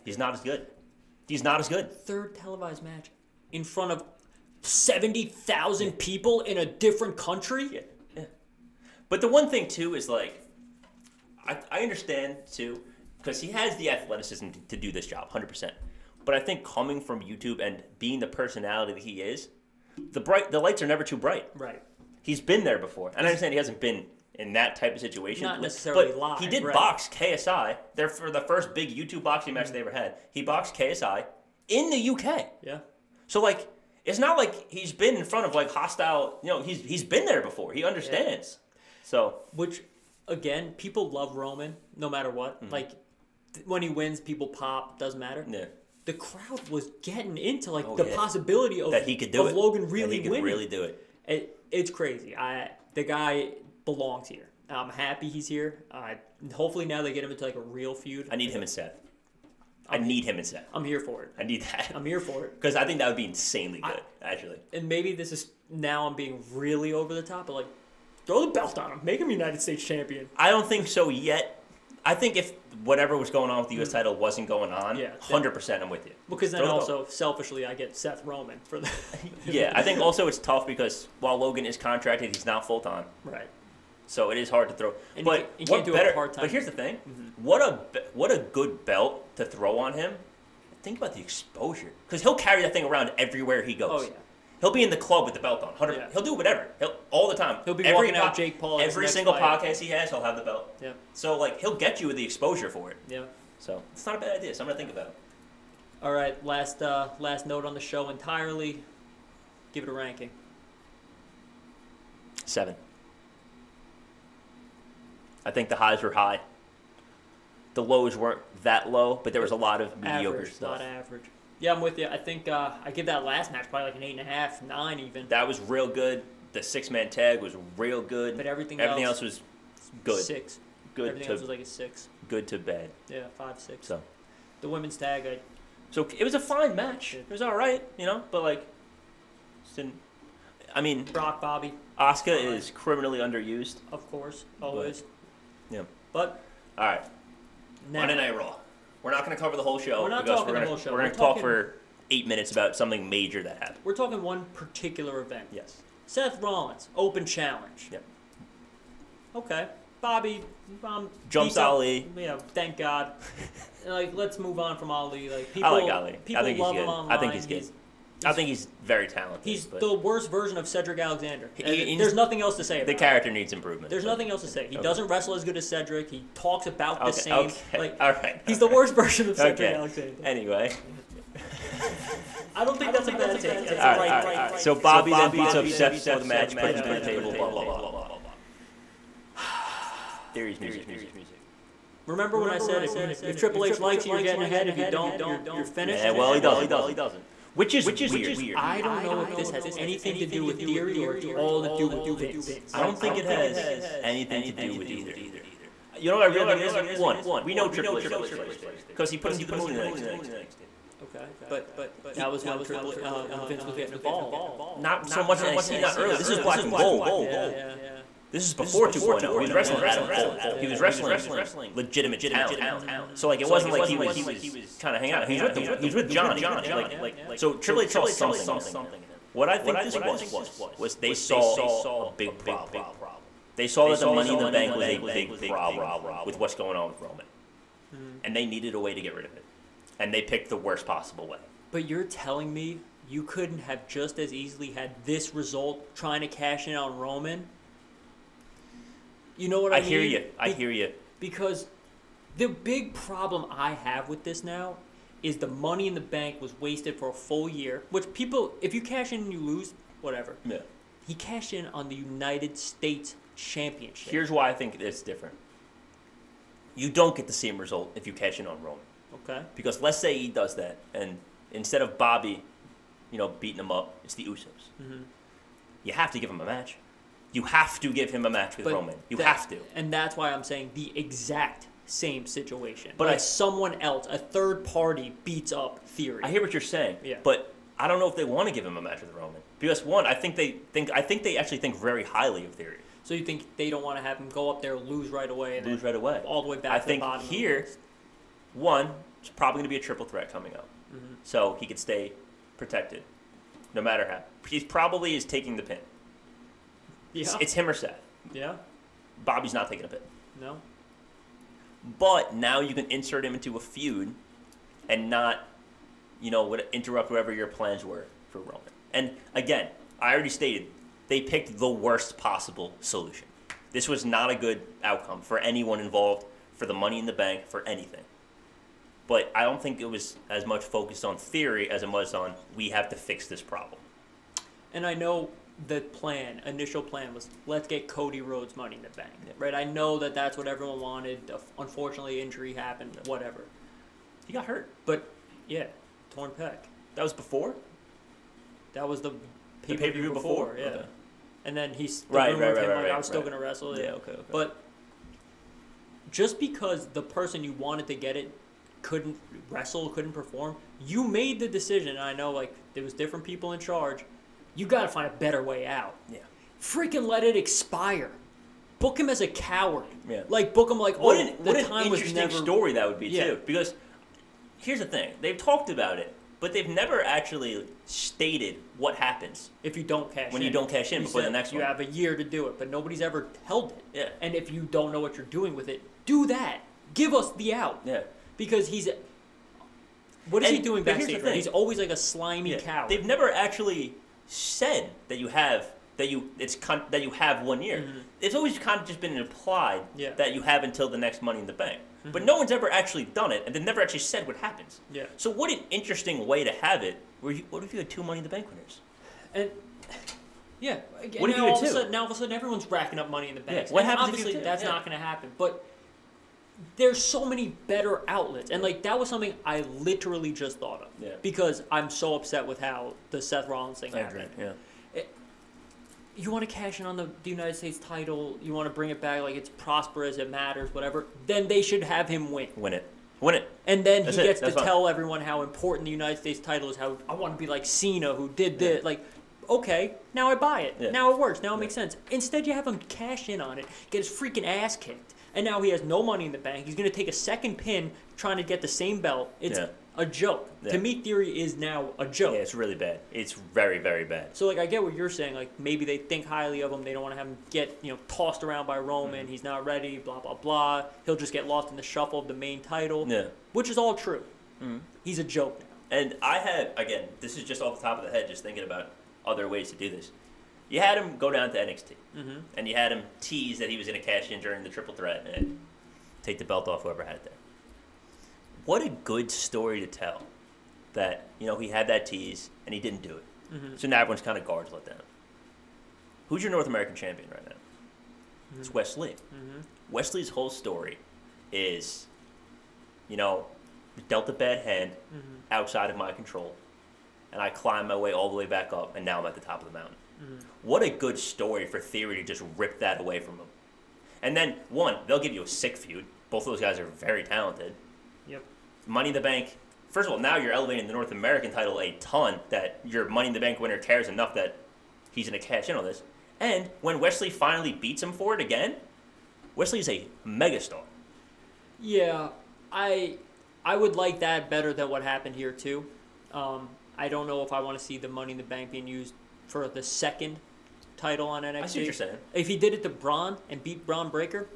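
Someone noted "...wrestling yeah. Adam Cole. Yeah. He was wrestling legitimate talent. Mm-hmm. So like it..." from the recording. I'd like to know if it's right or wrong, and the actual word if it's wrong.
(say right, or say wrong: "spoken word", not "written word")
right.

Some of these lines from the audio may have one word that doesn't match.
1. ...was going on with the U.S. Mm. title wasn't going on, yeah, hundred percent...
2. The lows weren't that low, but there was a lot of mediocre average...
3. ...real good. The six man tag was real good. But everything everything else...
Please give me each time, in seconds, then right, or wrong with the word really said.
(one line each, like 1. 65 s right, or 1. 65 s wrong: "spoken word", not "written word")
1. 73 s right
2. 117 s right
3. 125 s right.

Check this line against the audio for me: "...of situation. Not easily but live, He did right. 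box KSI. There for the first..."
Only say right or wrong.
wrong.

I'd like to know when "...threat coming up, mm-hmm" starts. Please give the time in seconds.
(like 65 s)
300 s.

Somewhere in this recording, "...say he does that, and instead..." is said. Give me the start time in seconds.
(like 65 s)
269 s.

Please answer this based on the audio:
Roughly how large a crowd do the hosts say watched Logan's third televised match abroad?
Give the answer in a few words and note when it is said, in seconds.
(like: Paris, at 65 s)
70,000, at 4 s.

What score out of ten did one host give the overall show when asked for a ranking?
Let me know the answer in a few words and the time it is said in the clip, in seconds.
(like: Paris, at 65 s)
7, at 112 s.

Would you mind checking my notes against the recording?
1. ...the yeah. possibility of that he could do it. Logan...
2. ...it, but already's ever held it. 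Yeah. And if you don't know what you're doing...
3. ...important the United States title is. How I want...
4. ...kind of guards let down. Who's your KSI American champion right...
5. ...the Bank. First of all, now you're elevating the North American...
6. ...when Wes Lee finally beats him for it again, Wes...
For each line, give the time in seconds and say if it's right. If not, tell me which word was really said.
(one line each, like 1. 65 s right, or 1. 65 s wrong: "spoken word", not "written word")
1. 47 s right
2. 382 s wrong: "nobody", not "already"
3. 435 s right
4. 484 s wrong: "North", not "KSI"
5. 509 s right
6. 516 s right.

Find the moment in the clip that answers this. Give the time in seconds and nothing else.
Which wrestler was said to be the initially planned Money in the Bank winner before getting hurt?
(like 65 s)
337 s.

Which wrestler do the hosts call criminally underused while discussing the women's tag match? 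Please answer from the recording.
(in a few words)
Asuka.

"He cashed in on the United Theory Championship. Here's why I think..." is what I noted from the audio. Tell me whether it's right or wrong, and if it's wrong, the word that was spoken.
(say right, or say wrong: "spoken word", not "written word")
wrong: "States", not "Theory".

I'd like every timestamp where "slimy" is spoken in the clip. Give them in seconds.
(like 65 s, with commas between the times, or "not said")
391 s.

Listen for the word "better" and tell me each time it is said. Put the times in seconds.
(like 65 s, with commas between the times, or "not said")
85 s, 365 s, 417 s, 524 s.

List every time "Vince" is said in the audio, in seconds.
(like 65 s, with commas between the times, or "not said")
202 s, 213 s.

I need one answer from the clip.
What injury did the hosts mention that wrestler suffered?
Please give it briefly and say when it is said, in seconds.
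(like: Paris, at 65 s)
torn pec, at 346 s.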